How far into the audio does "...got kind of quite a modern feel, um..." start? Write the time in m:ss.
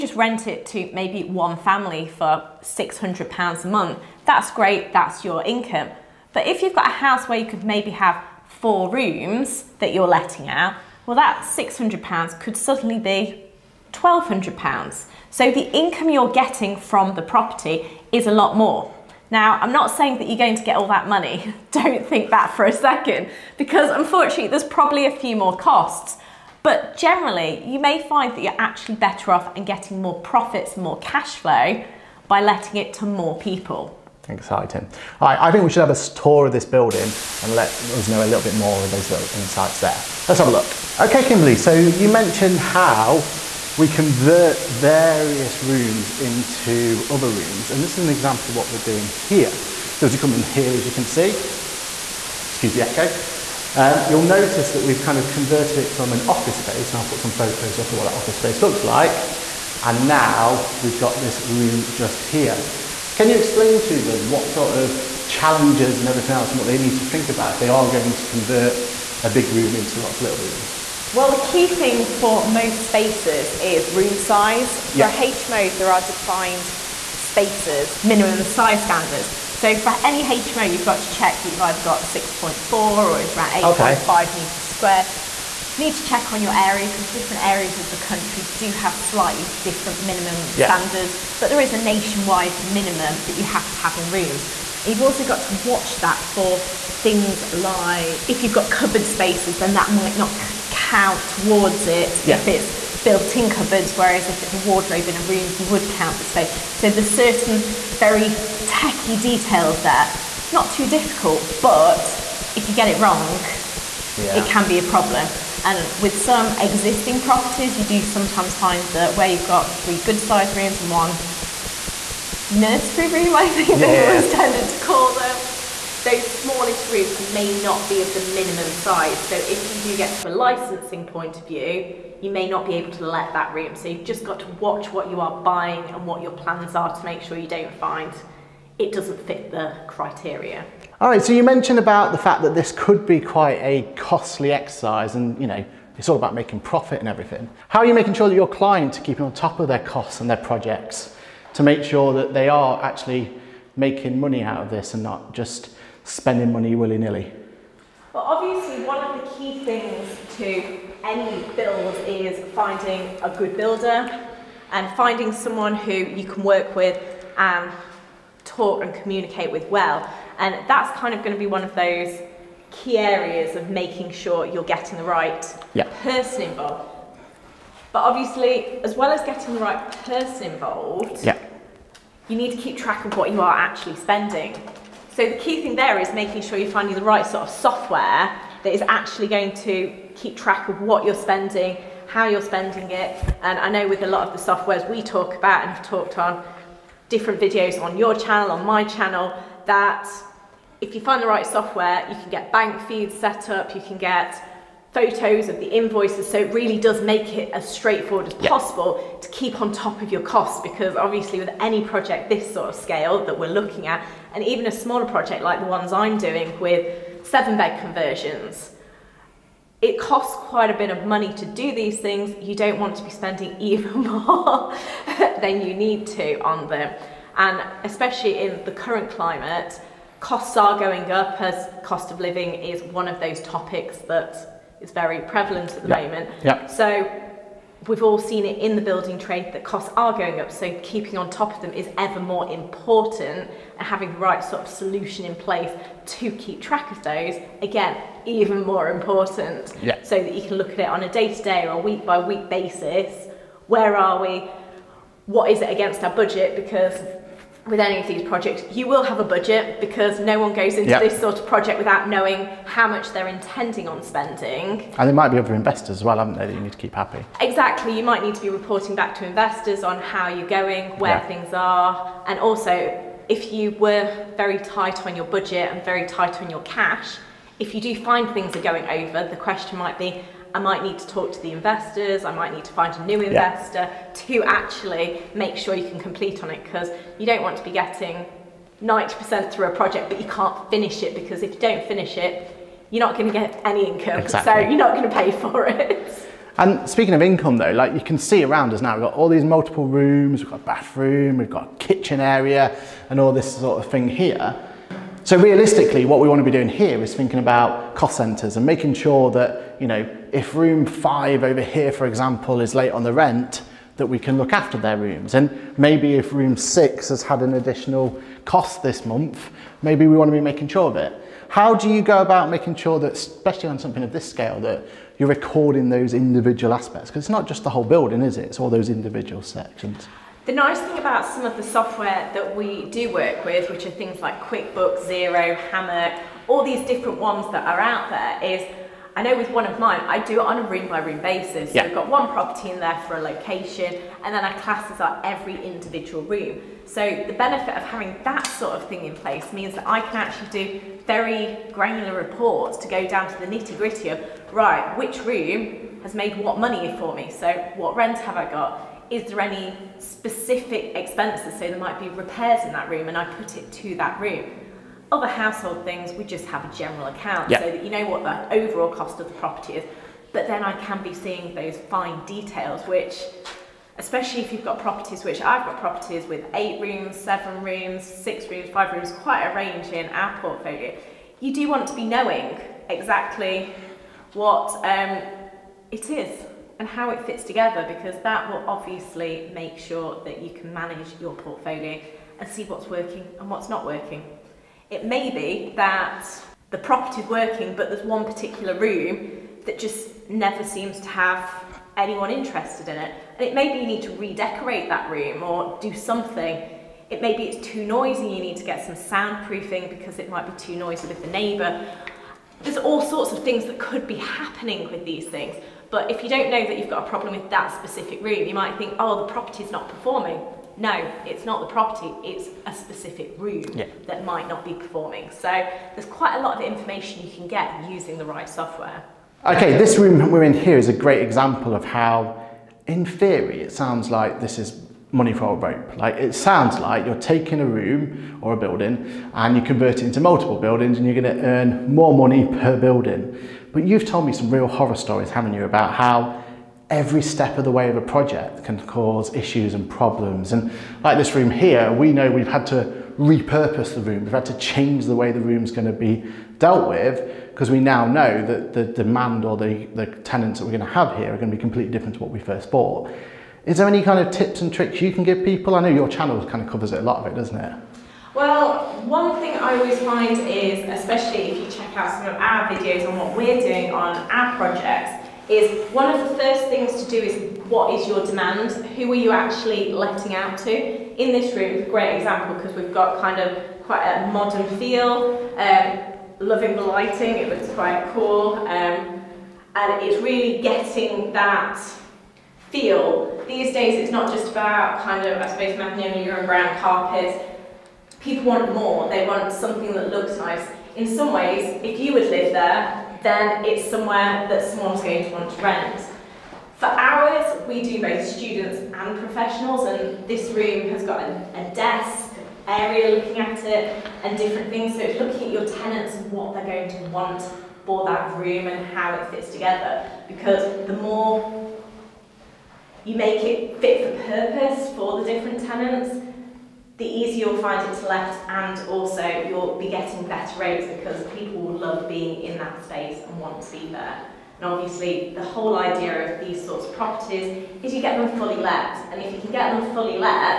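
8:02.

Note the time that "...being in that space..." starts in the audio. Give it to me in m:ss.
8:52.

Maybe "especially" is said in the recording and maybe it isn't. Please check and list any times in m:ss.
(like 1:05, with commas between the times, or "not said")
3:47, 5:23, 6:13, 7:50.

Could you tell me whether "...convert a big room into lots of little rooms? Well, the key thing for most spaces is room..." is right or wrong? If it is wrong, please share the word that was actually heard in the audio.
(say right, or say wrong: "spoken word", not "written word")
right.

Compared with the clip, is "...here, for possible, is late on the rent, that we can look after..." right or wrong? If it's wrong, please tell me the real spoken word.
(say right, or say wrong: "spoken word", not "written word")
wrong: "example", not "possible".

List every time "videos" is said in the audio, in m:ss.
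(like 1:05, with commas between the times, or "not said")
3:17, 7:52.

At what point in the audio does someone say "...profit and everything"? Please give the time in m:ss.
2:26.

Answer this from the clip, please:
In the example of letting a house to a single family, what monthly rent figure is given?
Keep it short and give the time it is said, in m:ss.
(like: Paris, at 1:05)
£600, at 0:02.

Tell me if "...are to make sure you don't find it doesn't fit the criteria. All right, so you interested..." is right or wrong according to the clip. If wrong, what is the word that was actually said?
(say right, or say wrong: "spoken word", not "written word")
wrong: "mentioned", not "interested".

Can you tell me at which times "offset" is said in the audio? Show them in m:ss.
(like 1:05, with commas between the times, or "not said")
not said.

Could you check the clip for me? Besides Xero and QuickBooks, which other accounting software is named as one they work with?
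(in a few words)
Hammock.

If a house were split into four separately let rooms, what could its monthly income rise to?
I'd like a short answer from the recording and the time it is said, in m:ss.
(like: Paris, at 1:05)
£1,200, at 0:13.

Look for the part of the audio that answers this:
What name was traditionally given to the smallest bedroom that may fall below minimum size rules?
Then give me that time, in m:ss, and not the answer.
2:02.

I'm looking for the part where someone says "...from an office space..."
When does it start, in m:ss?
0:55.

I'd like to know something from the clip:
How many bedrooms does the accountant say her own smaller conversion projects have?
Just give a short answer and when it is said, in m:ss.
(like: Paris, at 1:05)
7, at 3:37.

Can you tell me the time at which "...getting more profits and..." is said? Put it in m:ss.
0:29.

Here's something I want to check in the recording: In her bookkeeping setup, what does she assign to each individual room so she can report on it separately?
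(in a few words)
Classes.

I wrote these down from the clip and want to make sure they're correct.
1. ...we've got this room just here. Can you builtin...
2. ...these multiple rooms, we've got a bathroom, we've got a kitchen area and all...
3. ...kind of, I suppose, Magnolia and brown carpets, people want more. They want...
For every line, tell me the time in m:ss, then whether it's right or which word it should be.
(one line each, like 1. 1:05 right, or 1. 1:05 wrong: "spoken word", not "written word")
1. 1:00 wrong: "explain", not "builtin"
2. 4:59 right
3. 8:15 right.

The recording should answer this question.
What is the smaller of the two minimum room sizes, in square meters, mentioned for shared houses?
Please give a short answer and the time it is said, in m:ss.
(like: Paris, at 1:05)
6.4, at 1:22.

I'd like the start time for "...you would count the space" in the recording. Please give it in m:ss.
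1:45.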